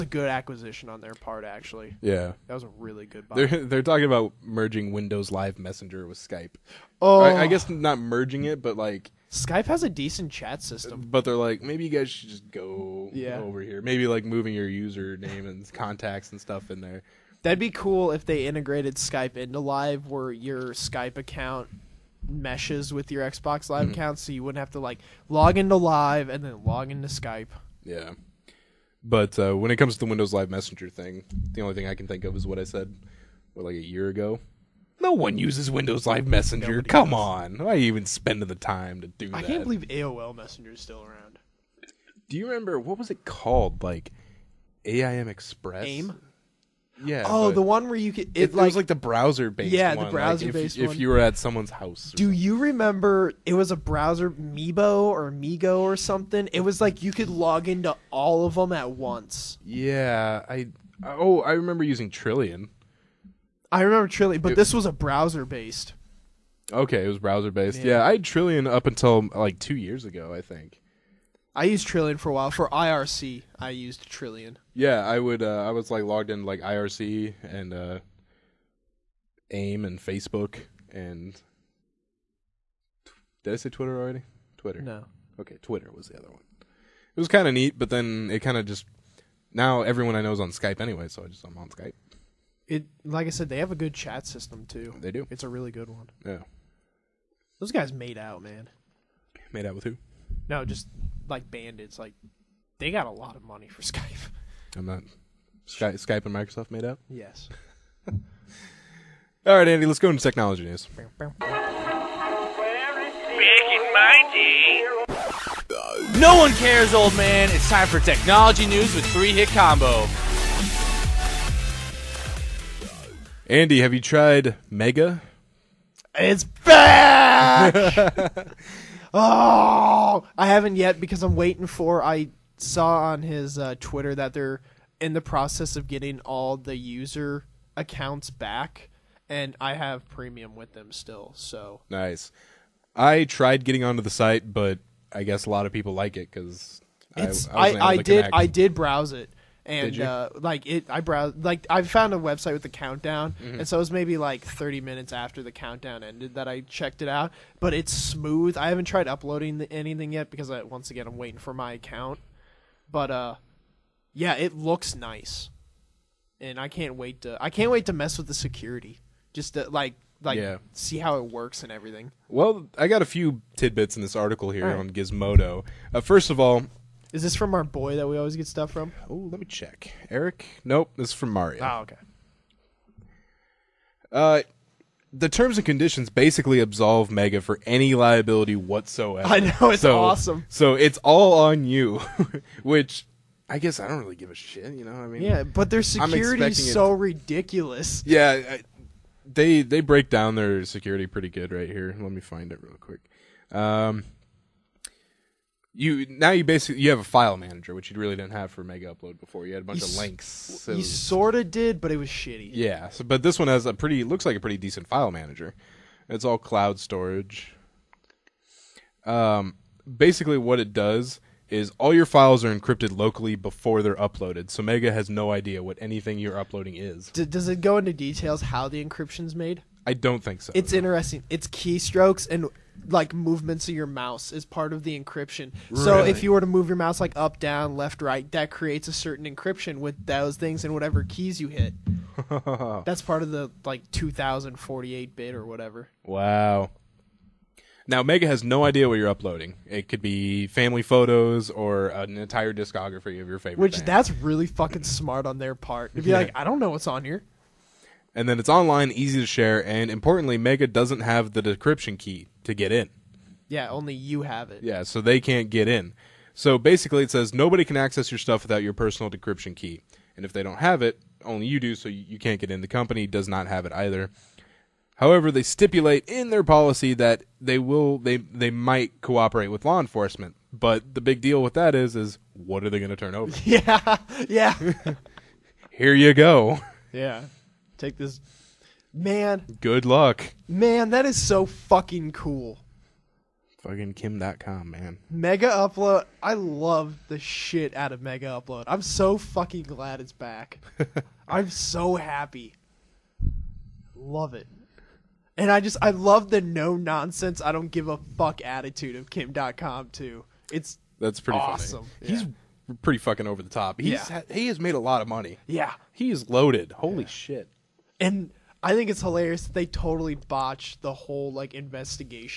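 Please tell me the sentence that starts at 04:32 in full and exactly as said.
The company does not have it either.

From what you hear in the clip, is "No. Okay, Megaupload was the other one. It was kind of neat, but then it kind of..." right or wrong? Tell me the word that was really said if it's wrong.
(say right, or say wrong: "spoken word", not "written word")
wrong: "Twitter", not "Megaupload".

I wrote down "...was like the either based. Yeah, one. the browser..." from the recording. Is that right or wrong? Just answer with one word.
wrong.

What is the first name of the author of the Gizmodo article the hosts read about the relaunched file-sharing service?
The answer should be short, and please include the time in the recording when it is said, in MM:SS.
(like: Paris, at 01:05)
Mario, at 03:01.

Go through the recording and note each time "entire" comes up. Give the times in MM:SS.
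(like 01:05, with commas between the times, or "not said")
04:12.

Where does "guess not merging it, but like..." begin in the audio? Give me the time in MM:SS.
00:07.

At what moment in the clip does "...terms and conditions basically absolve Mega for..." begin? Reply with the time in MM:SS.
03:05.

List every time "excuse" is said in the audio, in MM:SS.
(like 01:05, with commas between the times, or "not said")
not said.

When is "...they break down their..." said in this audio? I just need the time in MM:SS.
03:19.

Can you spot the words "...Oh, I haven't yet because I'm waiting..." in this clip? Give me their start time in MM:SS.
02:09.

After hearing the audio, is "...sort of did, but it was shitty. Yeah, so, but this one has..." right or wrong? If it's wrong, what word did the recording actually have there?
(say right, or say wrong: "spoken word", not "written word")
right.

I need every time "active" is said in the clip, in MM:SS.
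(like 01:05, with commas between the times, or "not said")
not said.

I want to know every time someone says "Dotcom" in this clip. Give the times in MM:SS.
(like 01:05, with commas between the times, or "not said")
04:54, 05:09.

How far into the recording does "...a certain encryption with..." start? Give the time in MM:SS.
03:58.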